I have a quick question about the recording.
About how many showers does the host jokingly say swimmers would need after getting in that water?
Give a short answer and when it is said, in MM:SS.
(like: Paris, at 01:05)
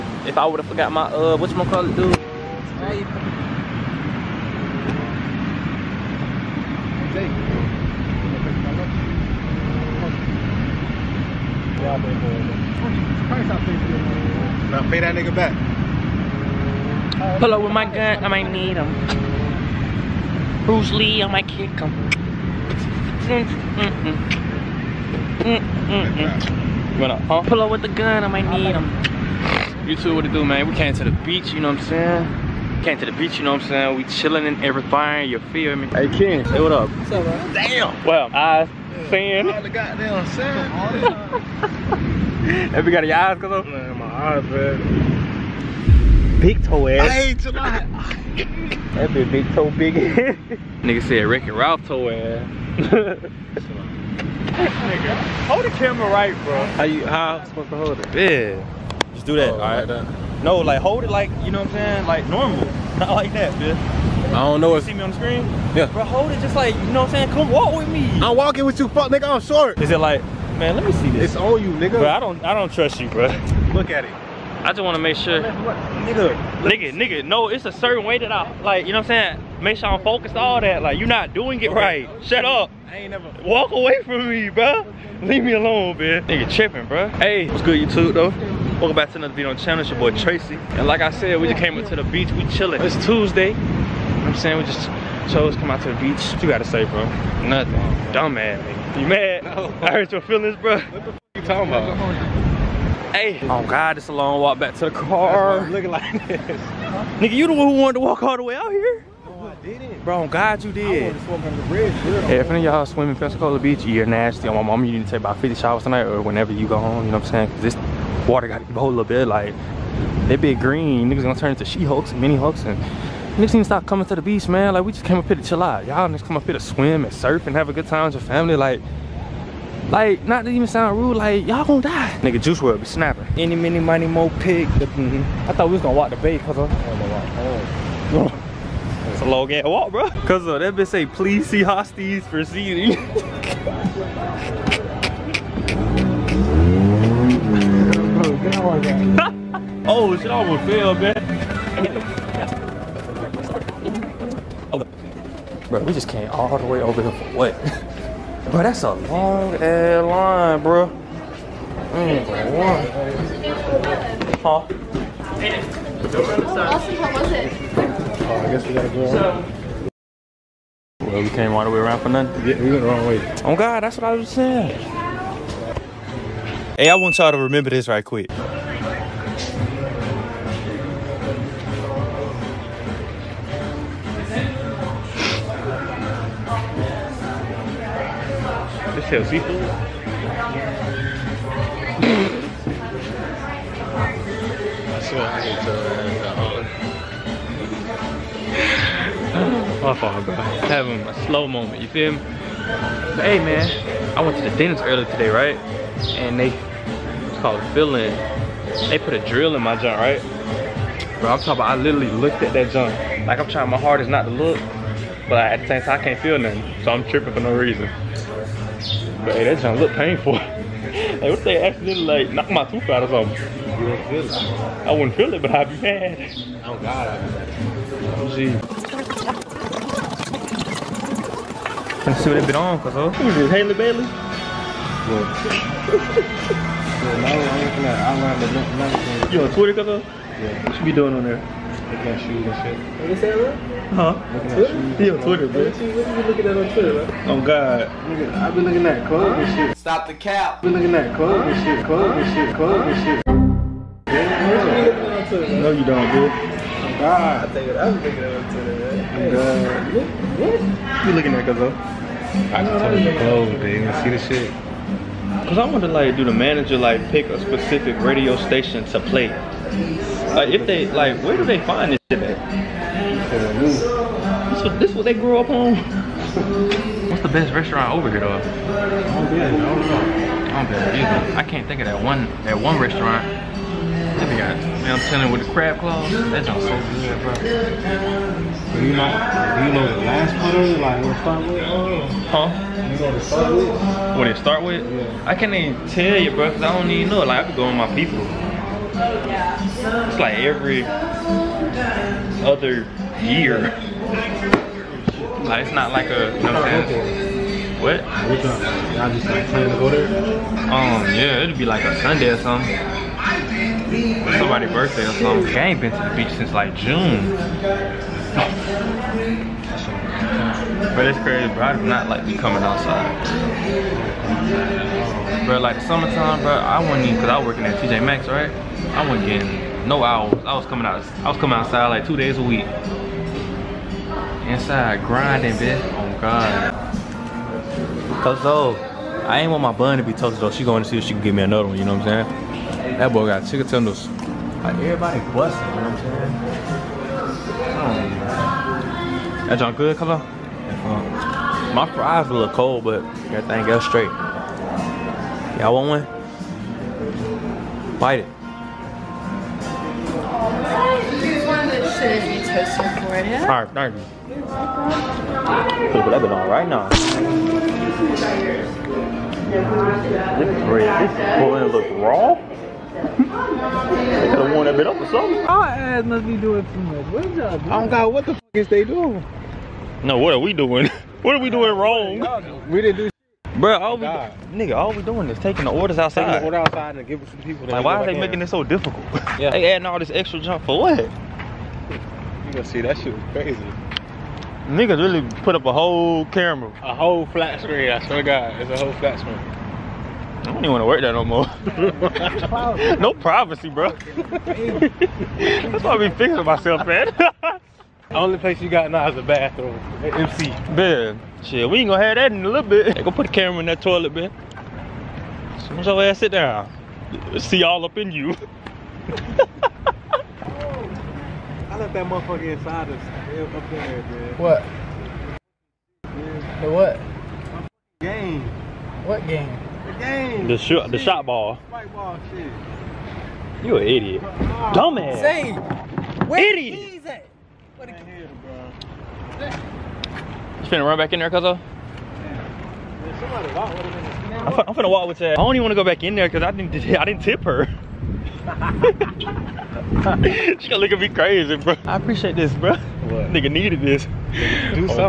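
50, at 01:55.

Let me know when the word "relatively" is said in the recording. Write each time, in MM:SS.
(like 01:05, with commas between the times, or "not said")
not said.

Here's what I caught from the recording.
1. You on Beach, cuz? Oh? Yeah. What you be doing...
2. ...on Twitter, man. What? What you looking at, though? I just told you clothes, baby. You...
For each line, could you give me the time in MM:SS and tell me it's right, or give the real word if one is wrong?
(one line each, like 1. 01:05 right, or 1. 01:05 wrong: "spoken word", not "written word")
1. 03:59 wrong: "Twitter", not "Beach"
2. 04:18 right.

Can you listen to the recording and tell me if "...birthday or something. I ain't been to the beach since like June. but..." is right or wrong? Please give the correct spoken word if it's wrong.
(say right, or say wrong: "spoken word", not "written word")
right.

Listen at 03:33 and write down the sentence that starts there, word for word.
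Like I'm trying my hardest not to look, but at the same time I can't feel nothing.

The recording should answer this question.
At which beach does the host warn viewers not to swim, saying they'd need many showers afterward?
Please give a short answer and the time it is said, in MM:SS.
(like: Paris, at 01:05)
Pensacola Beach, at 01:53.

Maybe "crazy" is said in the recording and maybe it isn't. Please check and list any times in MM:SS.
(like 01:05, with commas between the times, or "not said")
05:21, 06:33, 07:31.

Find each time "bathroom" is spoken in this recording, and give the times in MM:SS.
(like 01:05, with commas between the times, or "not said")
06:49.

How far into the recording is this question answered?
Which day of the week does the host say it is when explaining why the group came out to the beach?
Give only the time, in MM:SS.
01:33.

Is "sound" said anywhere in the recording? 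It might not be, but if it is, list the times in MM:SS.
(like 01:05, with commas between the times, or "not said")
02:10, 04:46.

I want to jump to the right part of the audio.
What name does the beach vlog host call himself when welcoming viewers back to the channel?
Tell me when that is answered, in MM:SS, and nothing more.
01:30.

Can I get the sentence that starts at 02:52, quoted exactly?
Yeah, we went the wrong way.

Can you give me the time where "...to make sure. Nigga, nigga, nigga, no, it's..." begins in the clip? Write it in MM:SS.
01:14.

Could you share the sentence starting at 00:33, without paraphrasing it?
We chilling and everything, you feel me?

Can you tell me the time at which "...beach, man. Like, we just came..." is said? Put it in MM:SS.
02:04.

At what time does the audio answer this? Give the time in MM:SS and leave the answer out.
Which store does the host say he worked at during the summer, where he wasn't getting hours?
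05:27.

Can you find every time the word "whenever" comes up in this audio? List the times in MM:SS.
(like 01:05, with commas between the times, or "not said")
01:56.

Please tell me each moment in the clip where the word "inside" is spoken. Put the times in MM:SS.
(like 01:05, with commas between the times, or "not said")
05:34, 07:02.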